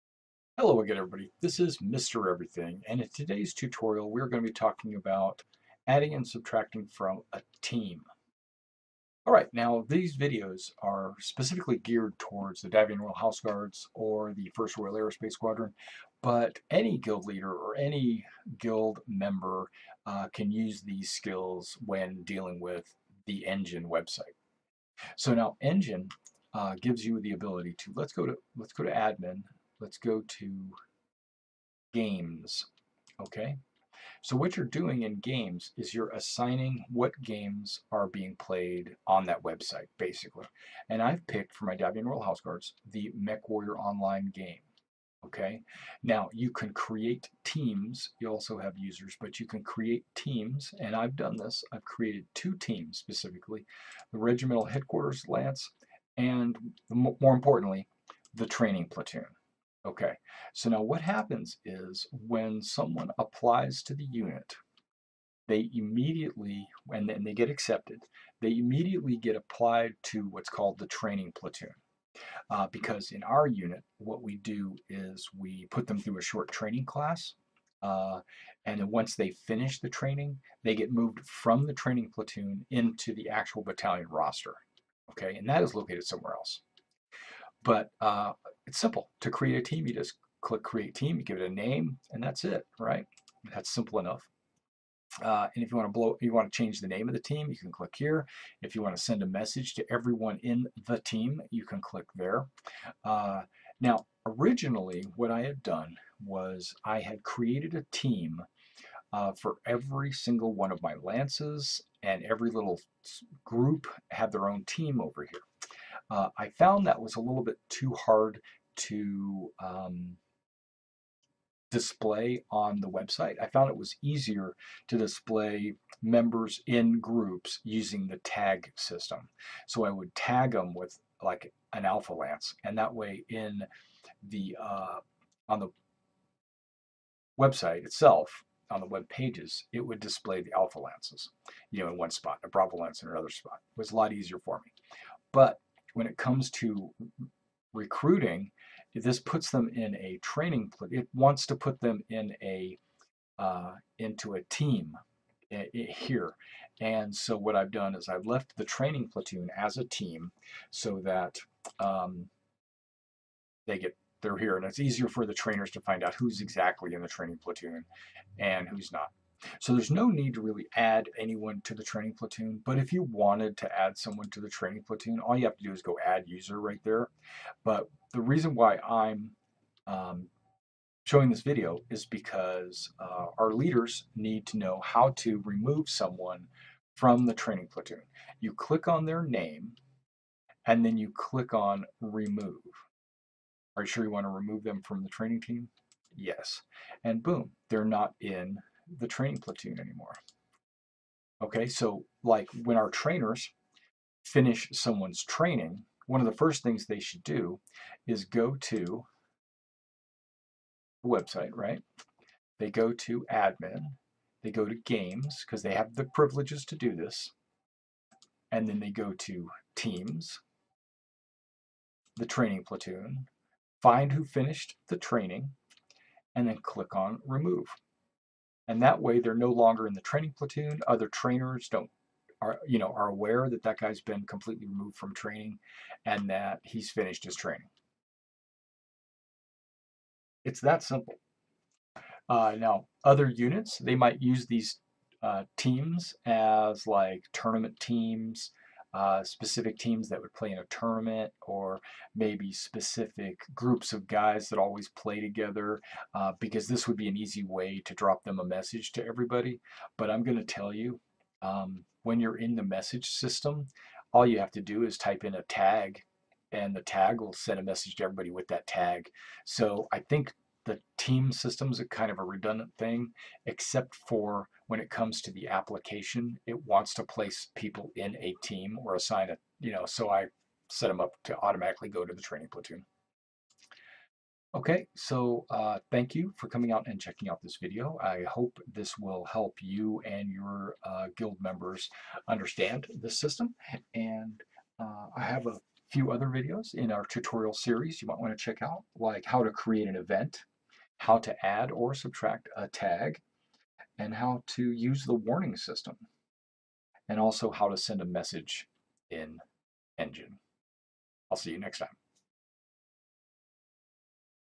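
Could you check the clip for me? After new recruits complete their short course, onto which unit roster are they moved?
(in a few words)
battalion roster.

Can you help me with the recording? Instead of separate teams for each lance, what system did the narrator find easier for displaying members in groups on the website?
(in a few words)
tag system.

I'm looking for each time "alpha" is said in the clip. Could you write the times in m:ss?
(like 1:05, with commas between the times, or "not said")
2:11, 2:20.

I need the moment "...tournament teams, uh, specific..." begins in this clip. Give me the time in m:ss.
4:07.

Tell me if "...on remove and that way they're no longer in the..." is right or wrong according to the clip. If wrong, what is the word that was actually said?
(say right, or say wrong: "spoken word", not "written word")
right.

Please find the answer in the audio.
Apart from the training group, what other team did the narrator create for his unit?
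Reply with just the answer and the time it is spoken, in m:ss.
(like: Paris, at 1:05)
Regimental Headquarters Lance, at 0:54.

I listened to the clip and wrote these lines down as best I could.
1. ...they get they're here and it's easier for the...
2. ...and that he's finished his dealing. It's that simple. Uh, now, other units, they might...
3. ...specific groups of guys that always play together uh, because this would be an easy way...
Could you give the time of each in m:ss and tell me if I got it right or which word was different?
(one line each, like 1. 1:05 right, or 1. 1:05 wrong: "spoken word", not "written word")
1. 2:43 right
2. 3:56 wrong: "training", not "dealing"
3. 4:12 right.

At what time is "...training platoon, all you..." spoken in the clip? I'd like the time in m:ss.
2:54.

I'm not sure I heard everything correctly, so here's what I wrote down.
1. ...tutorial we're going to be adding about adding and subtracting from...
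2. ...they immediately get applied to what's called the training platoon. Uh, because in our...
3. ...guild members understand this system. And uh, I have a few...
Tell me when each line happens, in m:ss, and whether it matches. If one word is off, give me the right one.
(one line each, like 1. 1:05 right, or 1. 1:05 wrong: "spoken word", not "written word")
1. 0:03 wrong: "talking", not "adding"
2. 1:08 right
3. 4:51 right.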